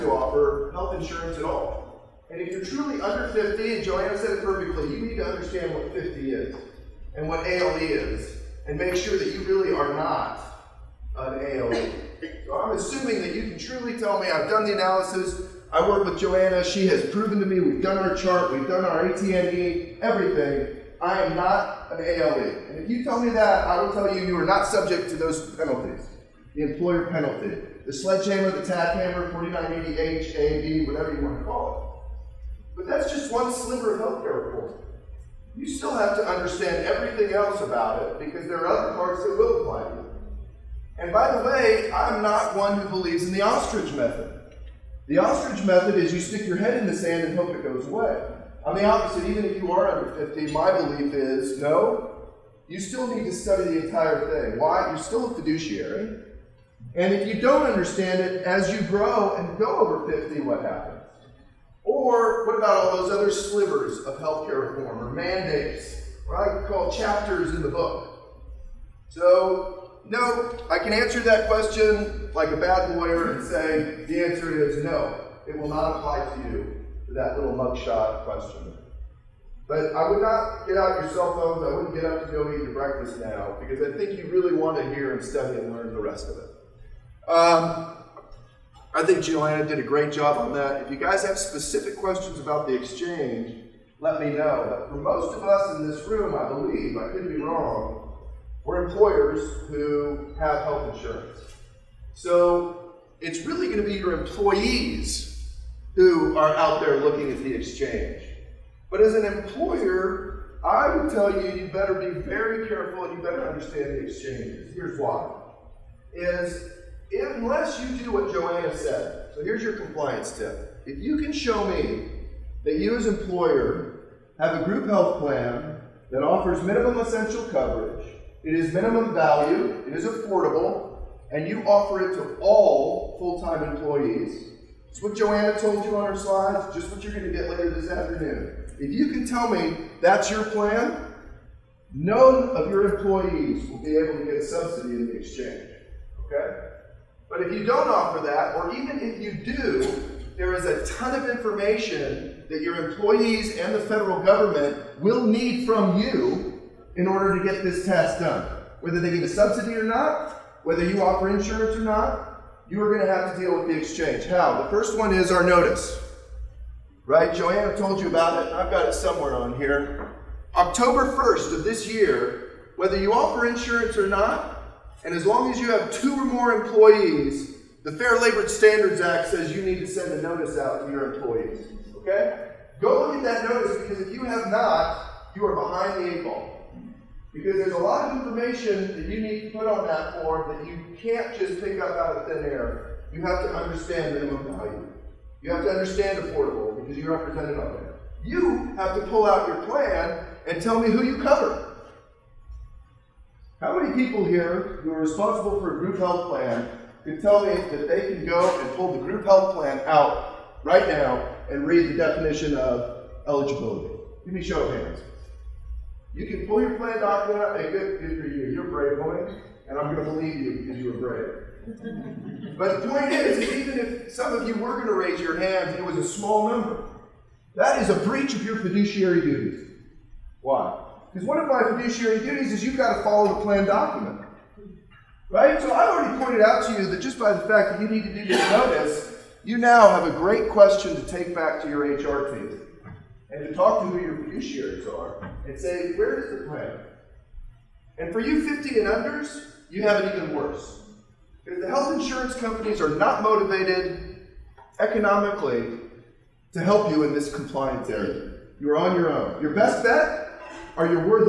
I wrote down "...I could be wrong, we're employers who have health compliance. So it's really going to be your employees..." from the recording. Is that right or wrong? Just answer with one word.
wrong.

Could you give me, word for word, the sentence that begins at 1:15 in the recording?
It will not apply to you for that little mugshot question.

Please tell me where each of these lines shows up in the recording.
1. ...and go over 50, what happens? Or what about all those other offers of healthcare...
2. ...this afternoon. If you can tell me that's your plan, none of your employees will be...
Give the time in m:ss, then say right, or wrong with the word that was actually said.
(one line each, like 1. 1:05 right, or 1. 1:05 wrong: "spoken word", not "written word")
1. 0:59 wrong: "slivers", not "offers"
2. 2:17 right.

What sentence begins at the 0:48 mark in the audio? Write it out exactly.
On the opposite, even if you are under 50, my belief is no, you still need to study the entire thing.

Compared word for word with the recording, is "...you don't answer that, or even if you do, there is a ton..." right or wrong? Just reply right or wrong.
wrong.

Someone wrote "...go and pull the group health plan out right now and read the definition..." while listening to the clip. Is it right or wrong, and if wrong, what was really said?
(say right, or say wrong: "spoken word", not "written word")
right.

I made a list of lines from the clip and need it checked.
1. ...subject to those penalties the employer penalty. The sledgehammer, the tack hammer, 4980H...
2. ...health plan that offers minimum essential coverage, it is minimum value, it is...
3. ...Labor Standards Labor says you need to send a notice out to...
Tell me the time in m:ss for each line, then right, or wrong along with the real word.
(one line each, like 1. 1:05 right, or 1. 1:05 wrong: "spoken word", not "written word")
1. 0:24 right
2. 2:04 right
3. 2:58 wrong: "Act", not "Labor".